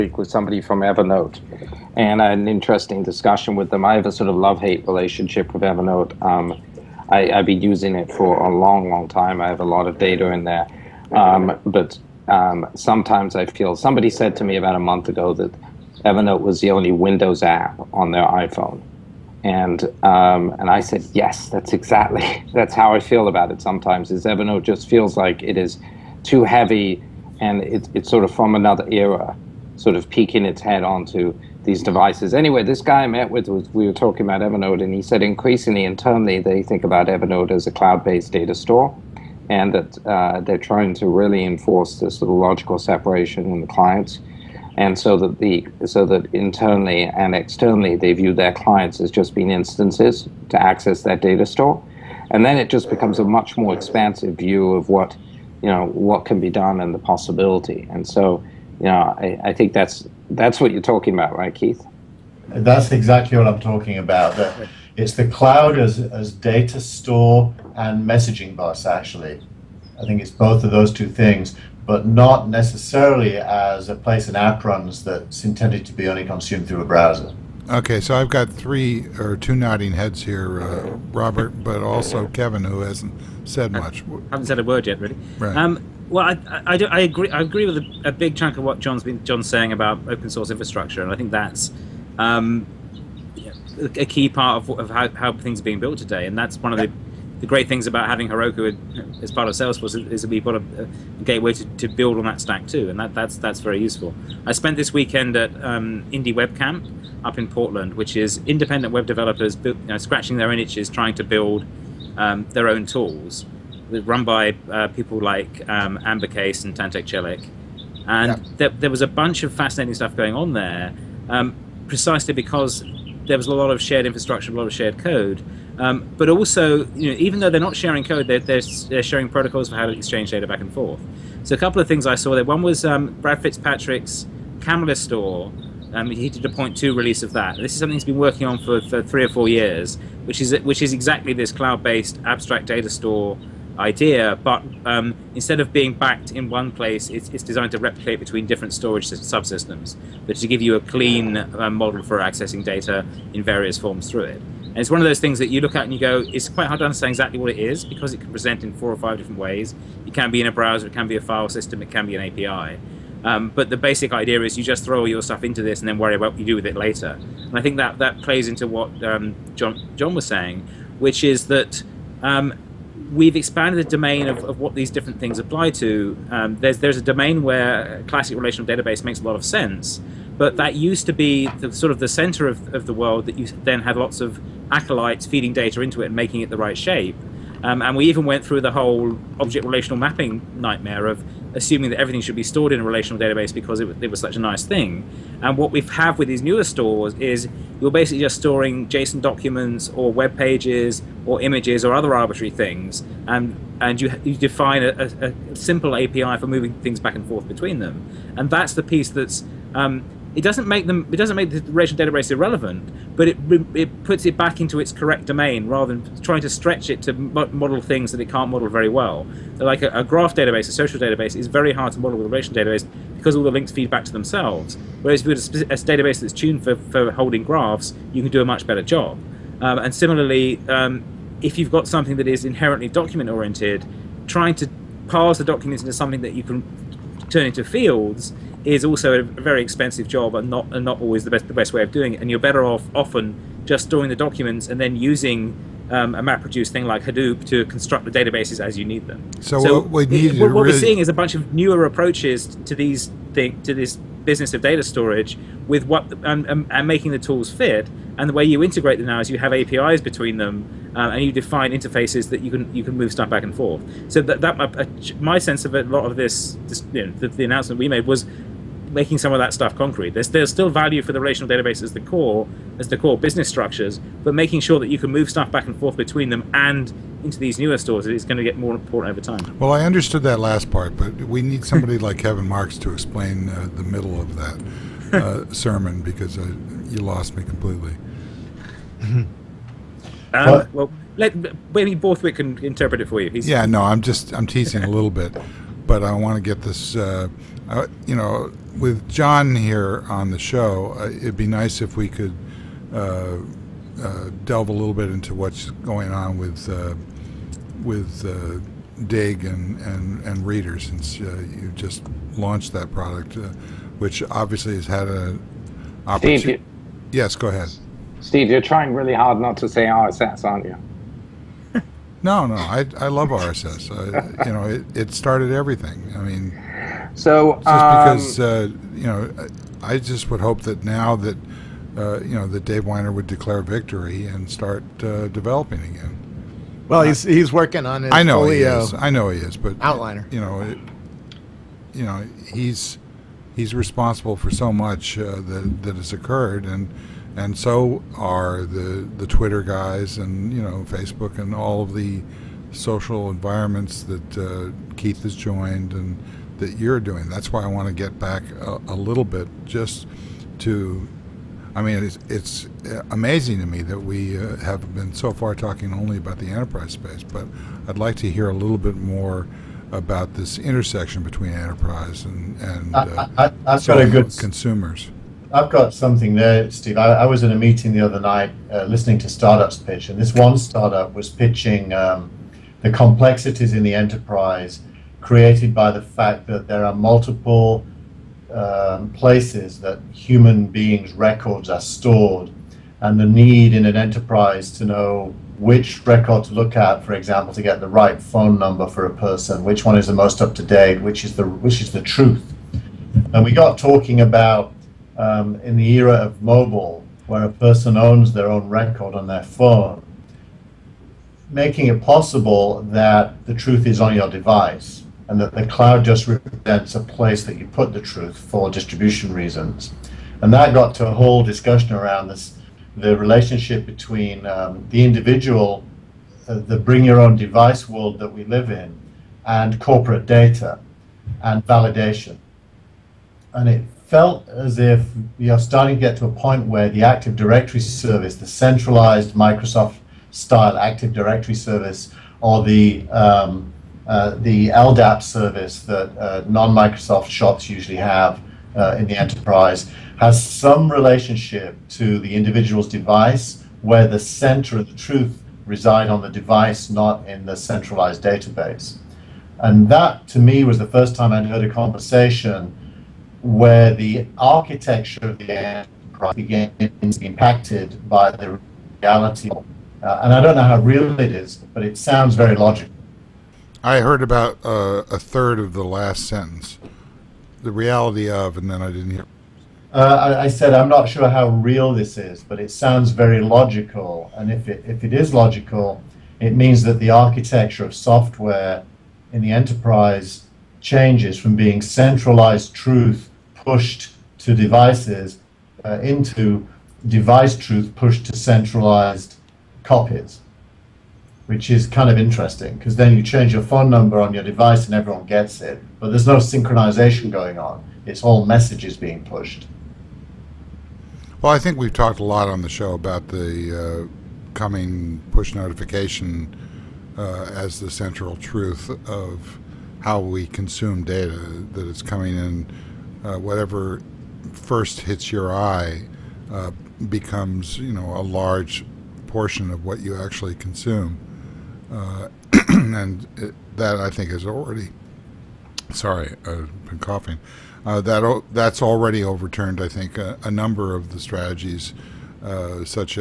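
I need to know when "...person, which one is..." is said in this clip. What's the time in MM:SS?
06:39.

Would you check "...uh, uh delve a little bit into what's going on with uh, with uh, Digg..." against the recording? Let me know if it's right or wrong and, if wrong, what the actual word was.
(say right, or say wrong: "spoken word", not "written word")
right.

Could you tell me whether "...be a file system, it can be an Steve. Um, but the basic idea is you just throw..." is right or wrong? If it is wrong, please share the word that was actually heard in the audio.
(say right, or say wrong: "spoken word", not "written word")
wrong: "API", not "Steve".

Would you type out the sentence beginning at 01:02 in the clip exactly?
That's exactly what I'm talking about.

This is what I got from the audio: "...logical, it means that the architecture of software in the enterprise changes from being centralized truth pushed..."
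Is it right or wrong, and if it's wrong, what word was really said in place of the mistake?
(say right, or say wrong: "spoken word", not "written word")
right.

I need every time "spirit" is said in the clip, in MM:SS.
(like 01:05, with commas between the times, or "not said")
not said.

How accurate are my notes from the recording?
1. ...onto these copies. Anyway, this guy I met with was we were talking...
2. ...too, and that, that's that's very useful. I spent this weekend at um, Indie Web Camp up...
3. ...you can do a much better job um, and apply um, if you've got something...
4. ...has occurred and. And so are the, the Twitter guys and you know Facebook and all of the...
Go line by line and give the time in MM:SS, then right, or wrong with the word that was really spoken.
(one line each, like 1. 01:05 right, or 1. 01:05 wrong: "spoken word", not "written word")
1. 00:30 wrong: "devices", not "copies"
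2. 01:42 right
3. 03:48 wrong: "similarly", not "apply"
4. 05:45 right.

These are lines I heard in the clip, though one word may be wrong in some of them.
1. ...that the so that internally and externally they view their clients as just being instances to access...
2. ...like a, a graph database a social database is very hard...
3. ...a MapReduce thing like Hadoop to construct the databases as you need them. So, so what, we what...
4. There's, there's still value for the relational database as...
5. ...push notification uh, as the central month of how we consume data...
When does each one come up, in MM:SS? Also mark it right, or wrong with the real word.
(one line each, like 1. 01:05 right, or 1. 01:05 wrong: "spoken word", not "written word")
1. 00:45 right
2. 03:39 right
3. 04:06 right
4. 04:30 right
5. 08:35 wrong: "truth", not "month".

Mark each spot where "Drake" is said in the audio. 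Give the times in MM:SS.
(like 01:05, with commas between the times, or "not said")
not said.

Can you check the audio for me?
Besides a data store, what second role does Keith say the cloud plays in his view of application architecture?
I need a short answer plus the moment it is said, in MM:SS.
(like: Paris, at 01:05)
Messaging bus, at 01:08.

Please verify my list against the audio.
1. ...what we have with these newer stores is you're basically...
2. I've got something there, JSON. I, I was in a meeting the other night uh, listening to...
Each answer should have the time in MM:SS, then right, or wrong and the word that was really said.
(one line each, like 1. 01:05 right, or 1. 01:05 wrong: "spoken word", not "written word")
1. 03:15 right
2. 06:15 wrong: "Steve", not "JSON".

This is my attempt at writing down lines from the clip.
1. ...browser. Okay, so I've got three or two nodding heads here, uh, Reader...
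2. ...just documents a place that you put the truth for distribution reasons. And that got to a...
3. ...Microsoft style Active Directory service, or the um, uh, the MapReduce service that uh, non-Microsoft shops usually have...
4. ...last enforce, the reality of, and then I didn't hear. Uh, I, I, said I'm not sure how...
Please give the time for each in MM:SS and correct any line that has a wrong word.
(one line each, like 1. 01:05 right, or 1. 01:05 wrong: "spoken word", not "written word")
1. 01:16 wrong: "Robert", not "Reader"
2. 06:56 wrong: "represents", not "documents"
3. 07:19 wrong: "LDAP", not "MapReduce"
4. 07:55 wrong: "sentence", not "enforce".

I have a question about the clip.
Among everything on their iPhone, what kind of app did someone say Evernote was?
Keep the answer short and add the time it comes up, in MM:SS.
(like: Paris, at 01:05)
Windows app, at 00:16.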